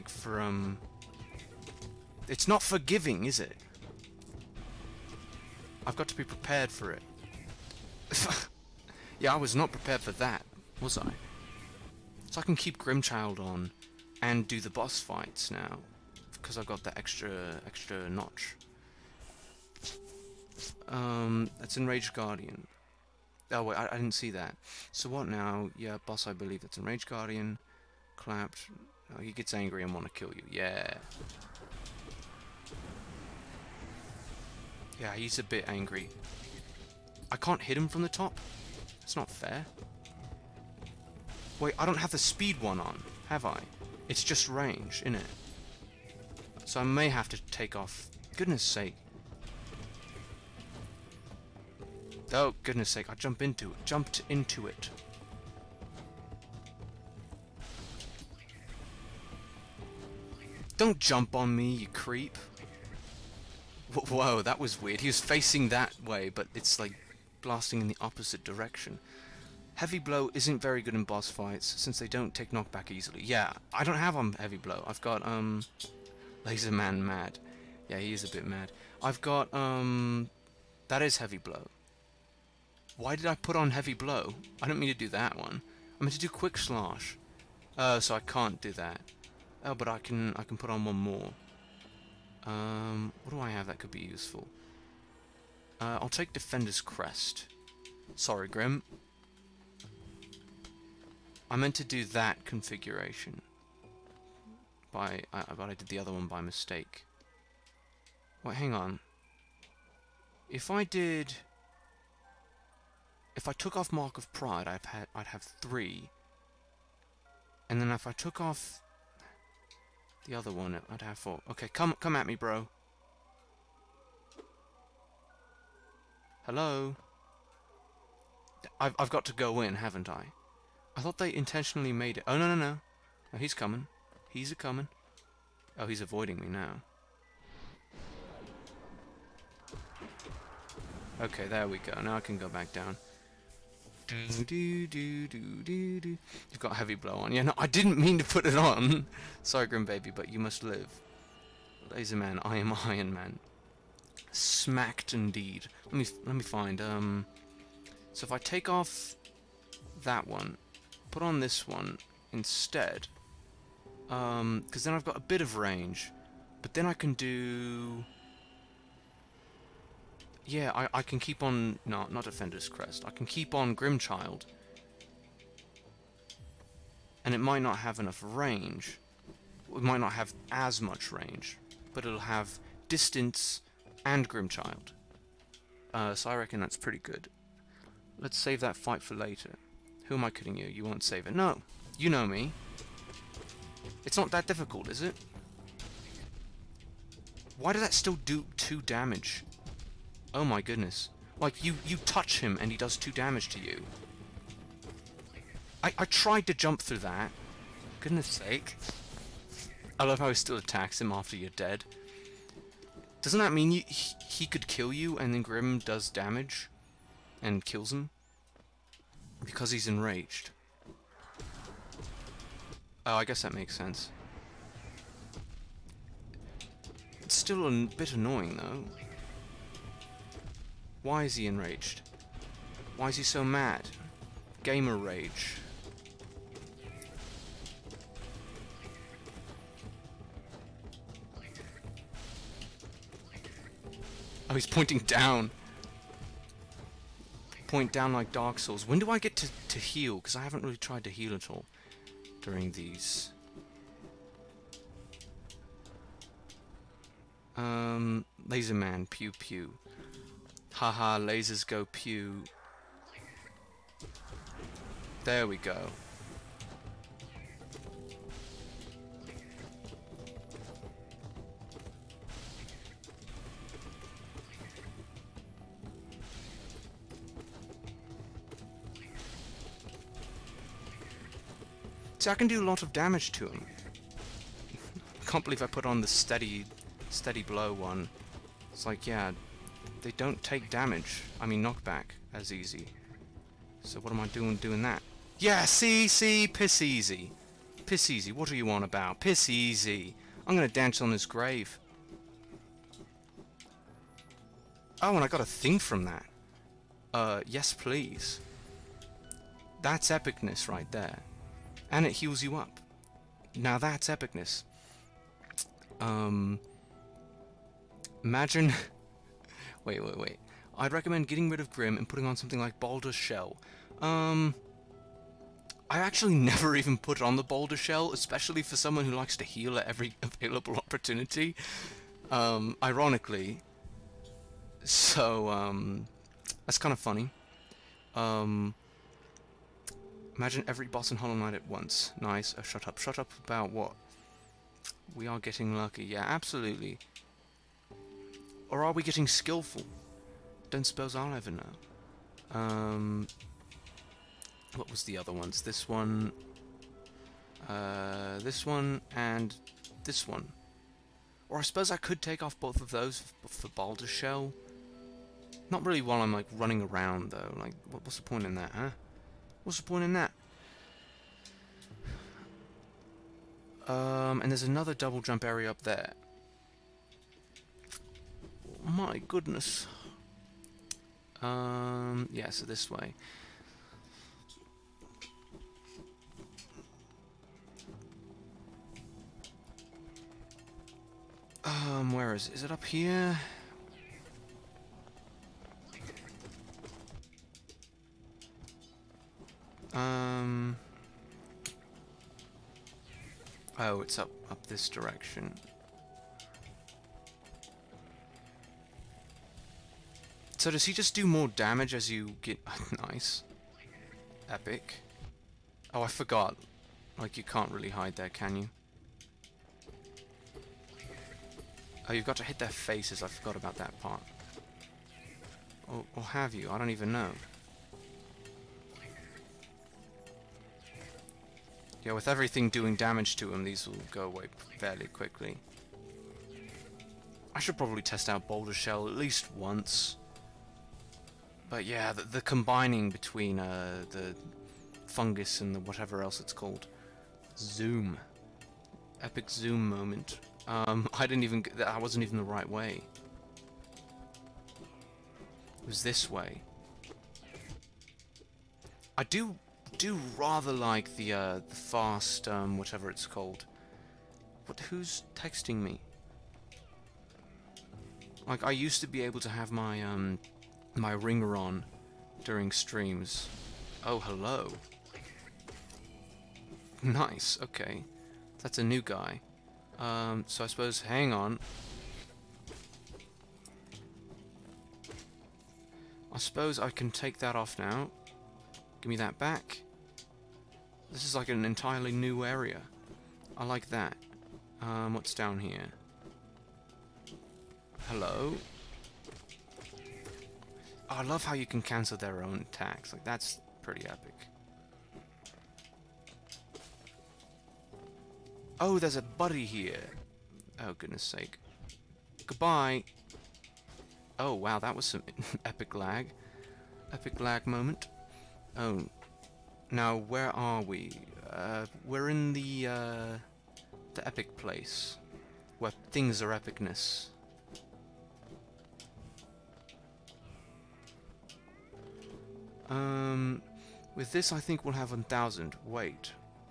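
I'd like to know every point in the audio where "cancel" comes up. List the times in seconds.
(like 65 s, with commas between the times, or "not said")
501 s.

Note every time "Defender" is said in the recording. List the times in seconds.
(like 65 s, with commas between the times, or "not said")
96 s, 172 s.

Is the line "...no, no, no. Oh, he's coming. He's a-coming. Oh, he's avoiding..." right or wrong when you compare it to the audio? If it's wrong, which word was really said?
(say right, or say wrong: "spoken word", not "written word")
right.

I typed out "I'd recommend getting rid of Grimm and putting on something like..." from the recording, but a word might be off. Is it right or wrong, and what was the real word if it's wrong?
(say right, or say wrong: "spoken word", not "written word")
right.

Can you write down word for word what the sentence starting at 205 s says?
I, I tried to jump through that.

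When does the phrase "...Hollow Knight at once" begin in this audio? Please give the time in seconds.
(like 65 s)
341 s.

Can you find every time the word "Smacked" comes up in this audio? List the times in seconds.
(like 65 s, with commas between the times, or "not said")
154 s.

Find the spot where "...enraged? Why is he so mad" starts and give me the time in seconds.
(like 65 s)
231 s.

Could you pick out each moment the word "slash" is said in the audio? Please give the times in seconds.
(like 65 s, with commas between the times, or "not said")
86 s.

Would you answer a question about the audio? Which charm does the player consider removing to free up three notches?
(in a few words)
Mark of Pride.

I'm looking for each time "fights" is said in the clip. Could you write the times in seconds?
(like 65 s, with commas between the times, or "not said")
14 s, 71 s, 188 s.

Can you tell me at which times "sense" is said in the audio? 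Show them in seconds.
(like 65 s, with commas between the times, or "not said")
223 s.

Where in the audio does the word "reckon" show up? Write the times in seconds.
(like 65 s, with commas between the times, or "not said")
186 s.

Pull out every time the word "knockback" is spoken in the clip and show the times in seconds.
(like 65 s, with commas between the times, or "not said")
72 s, 291 s.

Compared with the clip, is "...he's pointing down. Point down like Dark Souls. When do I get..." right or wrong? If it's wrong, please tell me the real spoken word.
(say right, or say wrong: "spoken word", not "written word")
right.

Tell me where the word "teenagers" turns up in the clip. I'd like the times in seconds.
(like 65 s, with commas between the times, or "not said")
not said.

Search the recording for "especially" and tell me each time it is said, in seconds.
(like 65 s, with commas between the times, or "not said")
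328 s.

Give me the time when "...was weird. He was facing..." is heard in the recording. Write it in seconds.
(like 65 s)
64 s.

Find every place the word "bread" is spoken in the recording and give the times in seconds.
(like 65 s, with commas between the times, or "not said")
not said.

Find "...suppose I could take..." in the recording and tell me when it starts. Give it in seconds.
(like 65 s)
361 s.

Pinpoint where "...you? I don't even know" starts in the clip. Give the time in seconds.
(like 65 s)
426 s.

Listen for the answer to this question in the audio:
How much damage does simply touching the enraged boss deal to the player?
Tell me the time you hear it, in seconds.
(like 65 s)
198 s.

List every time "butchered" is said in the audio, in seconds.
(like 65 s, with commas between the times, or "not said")
not said.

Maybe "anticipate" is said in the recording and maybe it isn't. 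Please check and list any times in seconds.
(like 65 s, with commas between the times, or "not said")
not said.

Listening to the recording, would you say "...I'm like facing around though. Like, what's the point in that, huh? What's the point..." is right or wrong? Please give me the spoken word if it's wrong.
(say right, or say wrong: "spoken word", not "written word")
wrong: "running", not "facing".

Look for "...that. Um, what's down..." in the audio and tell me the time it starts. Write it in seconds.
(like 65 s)
493 s.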